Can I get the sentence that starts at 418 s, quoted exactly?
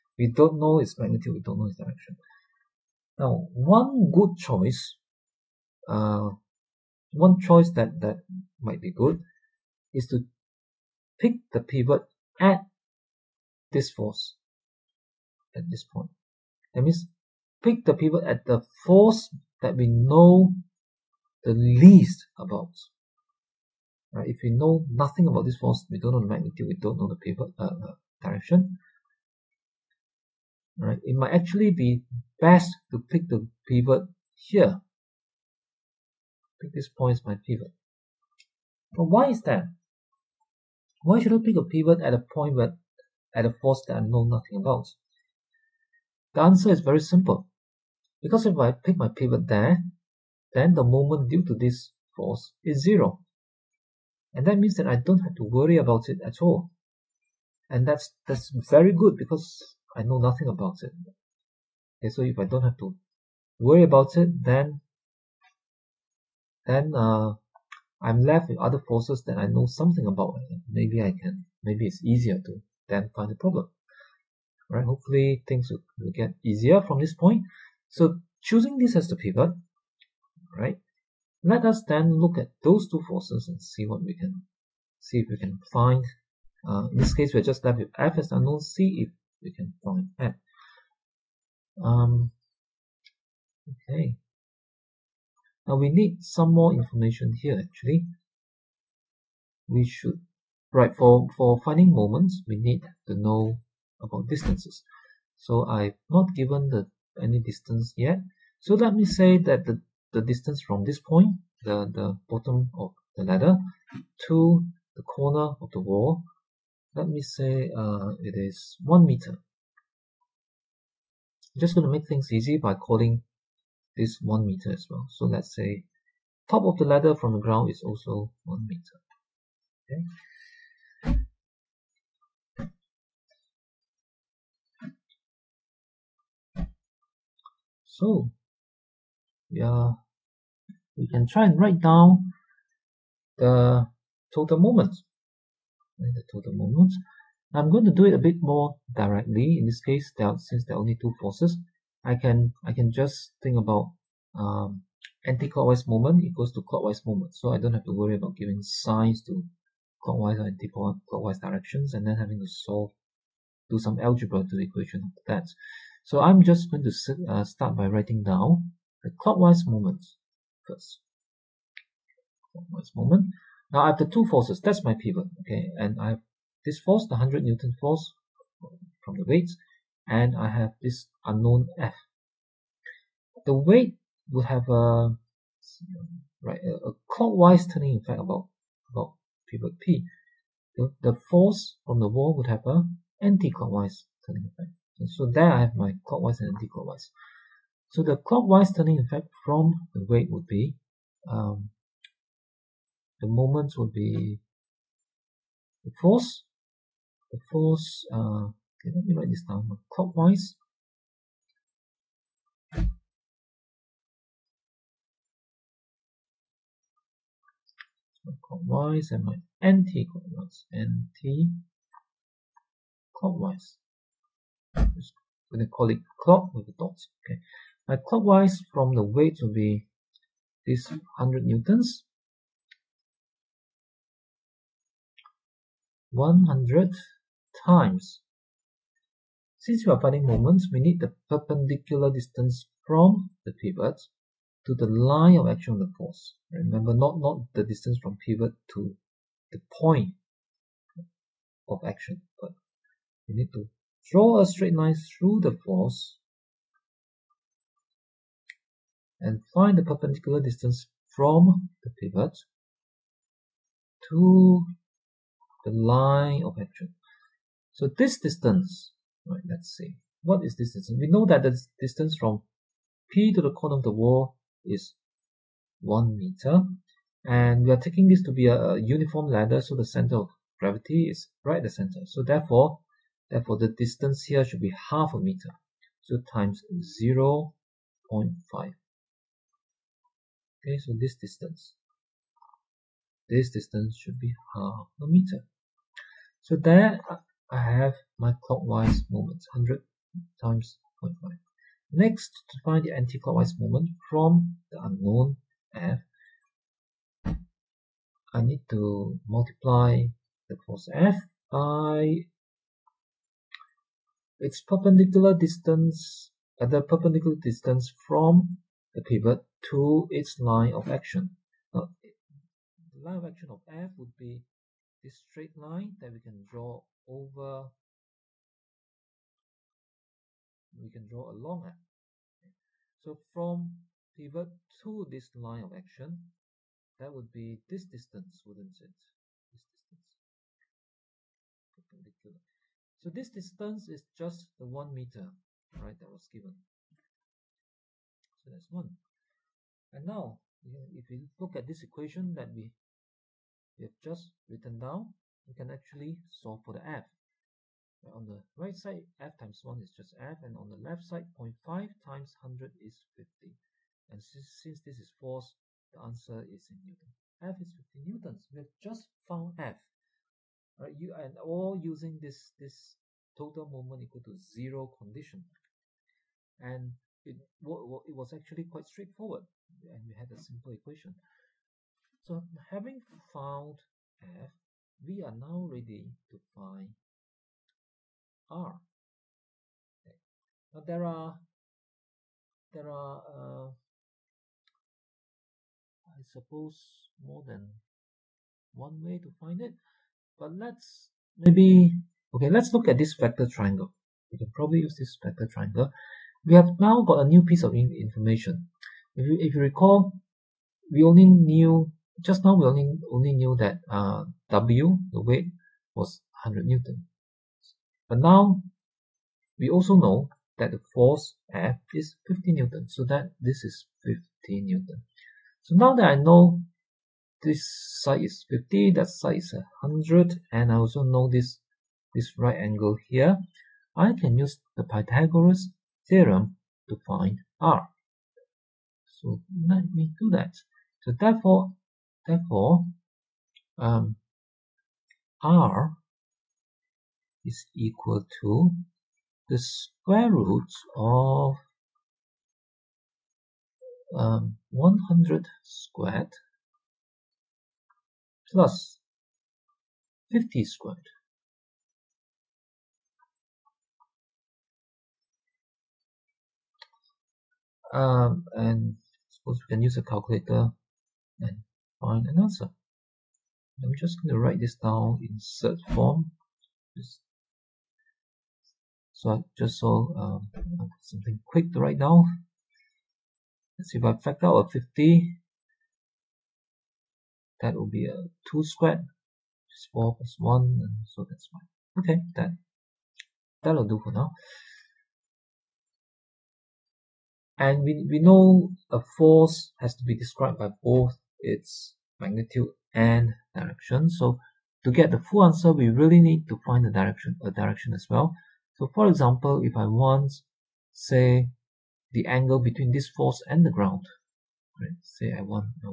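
But now we also know that the force F is 50 Newton, so that this is 50 Newton.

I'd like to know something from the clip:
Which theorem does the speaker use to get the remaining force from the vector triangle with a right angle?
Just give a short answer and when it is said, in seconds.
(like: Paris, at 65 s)
Pythagoras theorem, at 434 s.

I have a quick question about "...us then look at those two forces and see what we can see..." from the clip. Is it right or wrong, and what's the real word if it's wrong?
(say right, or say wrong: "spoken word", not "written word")
right.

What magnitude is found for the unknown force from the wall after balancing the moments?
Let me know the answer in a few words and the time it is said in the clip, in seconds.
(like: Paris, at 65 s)
50 newtons, at 367 s.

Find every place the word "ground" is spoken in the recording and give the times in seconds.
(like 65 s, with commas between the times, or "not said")
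127 s, 513 s.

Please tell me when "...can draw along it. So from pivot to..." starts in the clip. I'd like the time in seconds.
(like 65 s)
330 s.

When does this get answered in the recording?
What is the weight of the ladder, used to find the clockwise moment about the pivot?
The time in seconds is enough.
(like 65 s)
230 s.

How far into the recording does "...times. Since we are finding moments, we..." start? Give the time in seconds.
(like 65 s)
237 s.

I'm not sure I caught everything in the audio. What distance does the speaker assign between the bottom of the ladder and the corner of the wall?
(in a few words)
1 meter.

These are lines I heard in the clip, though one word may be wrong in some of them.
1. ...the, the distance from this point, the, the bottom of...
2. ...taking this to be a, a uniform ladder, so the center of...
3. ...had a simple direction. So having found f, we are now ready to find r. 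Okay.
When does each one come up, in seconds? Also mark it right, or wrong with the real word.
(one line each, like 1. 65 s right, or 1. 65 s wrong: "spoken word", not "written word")
1. 109 s right
2. 277 s right
3. 380 s wrong: "equation", not "direction".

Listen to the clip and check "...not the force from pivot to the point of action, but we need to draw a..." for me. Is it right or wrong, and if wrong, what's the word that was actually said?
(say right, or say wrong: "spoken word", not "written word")
wrong: "distance", not "force".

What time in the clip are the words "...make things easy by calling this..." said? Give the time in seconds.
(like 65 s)
121 s.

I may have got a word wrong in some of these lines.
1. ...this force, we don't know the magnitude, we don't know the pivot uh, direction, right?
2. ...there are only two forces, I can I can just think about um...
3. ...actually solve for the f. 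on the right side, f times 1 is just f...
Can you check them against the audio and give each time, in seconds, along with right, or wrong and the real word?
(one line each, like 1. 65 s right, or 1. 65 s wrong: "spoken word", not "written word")
1. 25 s right
2. 150 s right
3. 355 s right.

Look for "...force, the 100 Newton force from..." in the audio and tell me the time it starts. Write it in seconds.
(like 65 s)
176 s.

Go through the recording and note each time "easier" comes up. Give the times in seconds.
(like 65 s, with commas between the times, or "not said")
72 s, 76 s.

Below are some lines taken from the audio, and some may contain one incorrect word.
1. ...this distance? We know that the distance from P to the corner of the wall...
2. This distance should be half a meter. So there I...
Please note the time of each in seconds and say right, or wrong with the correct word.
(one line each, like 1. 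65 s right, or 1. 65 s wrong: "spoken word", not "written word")
1. 270 s right
2. 293 s right.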